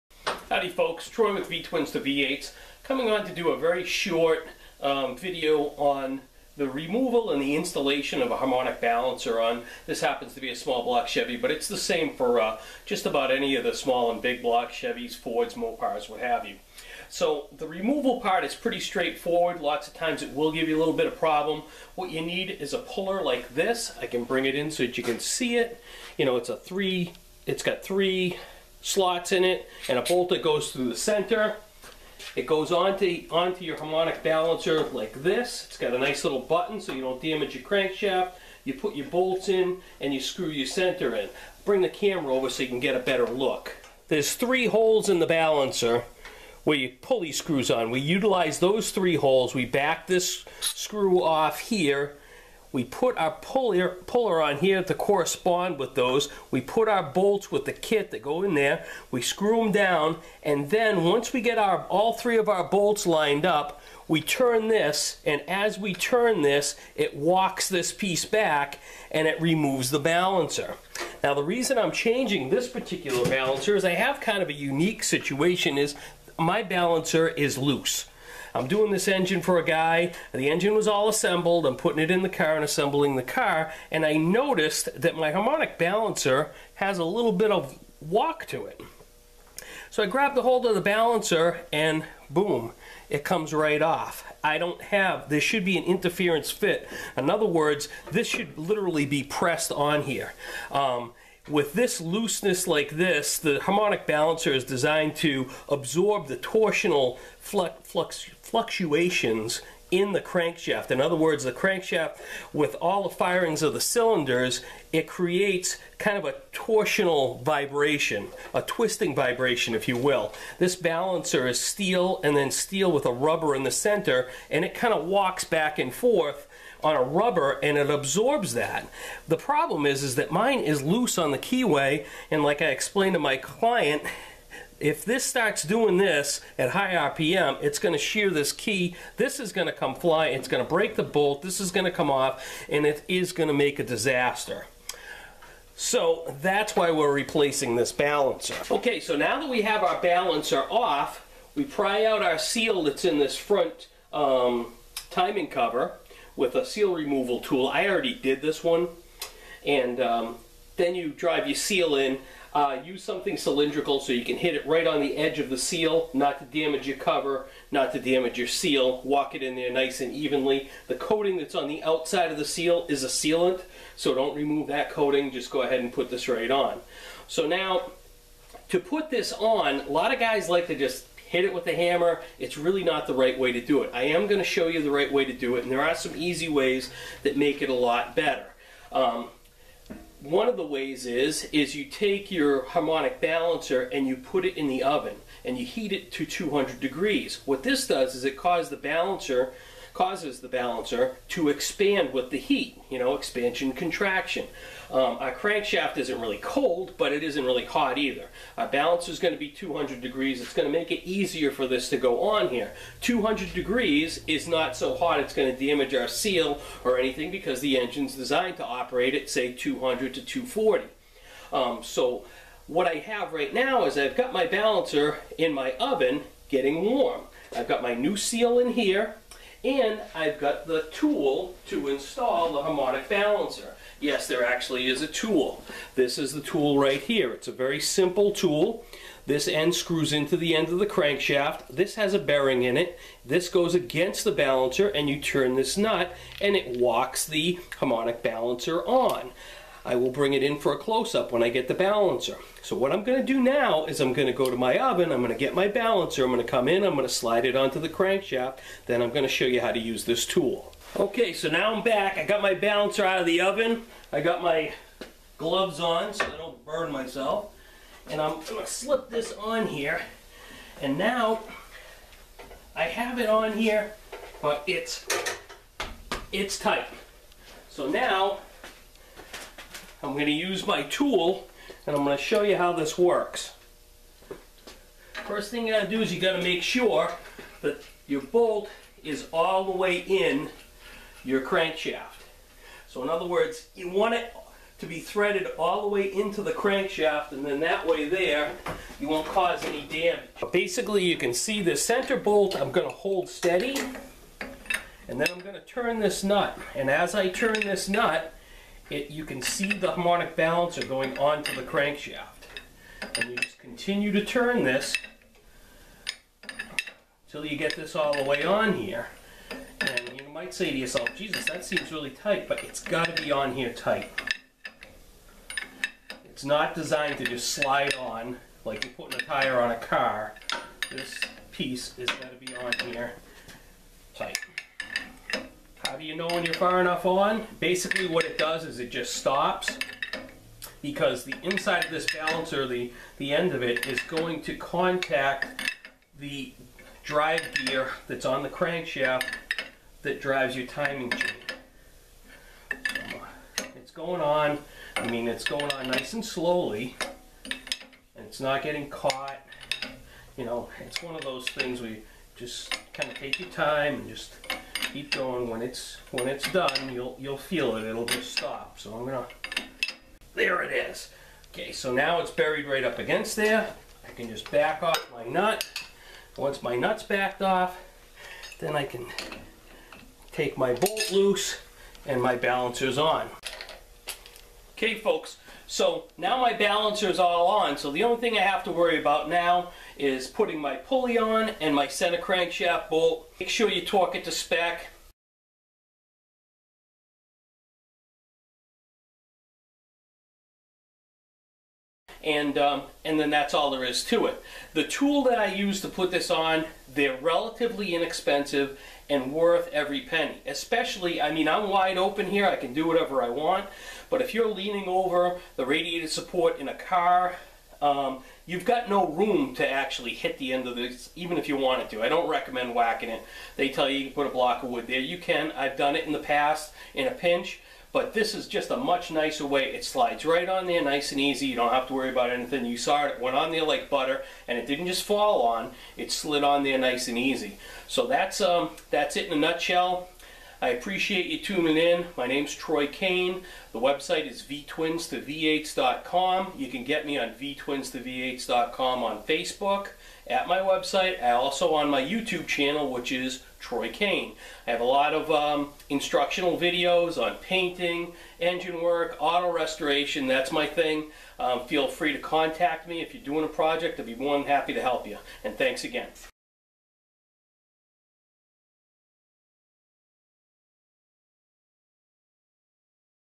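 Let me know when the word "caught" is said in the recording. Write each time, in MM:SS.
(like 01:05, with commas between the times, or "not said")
05:58.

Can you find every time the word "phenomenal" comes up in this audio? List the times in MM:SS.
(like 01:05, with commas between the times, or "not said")
not said.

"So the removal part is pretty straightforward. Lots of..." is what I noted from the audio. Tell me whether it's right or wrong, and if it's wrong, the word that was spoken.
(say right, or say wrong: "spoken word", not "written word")
right.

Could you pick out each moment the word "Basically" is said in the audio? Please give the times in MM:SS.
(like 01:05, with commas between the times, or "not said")
05:00, 05:37.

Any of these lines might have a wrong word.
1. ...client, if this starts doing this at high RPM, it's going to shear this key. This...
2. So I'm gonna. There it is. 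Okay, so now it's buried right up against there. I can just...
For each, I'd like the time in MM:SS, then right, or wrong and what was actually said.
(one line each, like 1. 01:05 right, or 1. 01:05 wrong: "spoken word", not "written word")
1. 02:13 right
2. 06:08 right.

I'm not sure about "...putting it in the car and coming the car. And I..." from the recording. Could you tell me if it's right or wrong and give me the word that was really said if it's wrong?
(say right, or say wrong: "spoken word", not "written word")
wrong: "assembling", not "coming".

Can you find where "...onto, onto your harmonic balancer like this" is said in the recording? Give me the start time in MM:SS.
00:32.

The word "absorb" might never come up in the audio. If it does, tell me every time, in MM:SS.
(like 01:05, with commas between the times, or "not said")
01:45, 02:07.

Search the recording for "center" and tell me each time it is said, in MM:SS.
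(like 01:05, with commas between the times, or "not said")
00:30, 00:40, 02:03, 05:01, 06:31.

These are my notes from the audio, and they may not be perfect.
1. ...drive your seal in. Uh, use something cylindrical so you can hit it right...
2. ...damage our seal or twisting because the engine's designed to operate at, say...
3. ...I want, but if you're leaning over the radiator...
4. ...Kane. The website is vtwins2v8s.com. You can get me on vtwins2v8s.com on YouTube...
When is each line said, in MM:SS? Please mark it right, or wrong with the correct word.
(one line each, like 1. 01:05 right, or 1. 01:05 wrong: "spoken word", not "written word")
1. 02:41 right
2. 03:35 wrong: "anything", not "twisting"
3. 06:53 right
4. 07:22 wrong: "Facebook", not "YouTube".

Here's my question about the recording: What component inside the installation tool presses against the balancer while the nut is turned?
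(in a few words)
A bearing.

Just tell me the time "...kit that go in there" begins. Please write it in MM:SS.
00:57.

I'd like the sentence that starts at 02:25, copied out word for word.
So that's why we're replacing this balancer.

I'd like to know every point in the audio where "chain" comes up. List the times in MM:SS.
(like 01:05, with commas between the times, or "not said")
05:51.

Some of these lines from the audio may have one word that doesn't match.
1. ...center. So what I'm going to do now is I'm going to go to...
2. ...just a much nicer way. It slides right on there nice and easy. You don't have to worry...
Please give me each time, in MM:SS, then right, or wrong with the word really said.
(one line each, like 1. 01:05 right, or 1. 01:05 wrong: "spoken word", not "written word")
1. 04:11 wrong: "balancer", not "center"
2. 07:08 right.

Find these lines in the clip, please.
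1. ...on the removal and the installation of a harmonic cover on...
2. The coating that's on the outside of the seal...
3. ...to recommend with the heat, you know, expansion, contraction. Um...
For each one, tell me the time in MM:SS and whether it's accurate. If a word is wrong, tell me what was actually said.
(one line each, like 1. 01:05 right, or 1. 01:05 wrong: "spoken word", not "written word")
1. 00:05 wrong: "balancer", not "cover"
2. 02:50 right
3. 03:21 wrong: "expand", not "recommend".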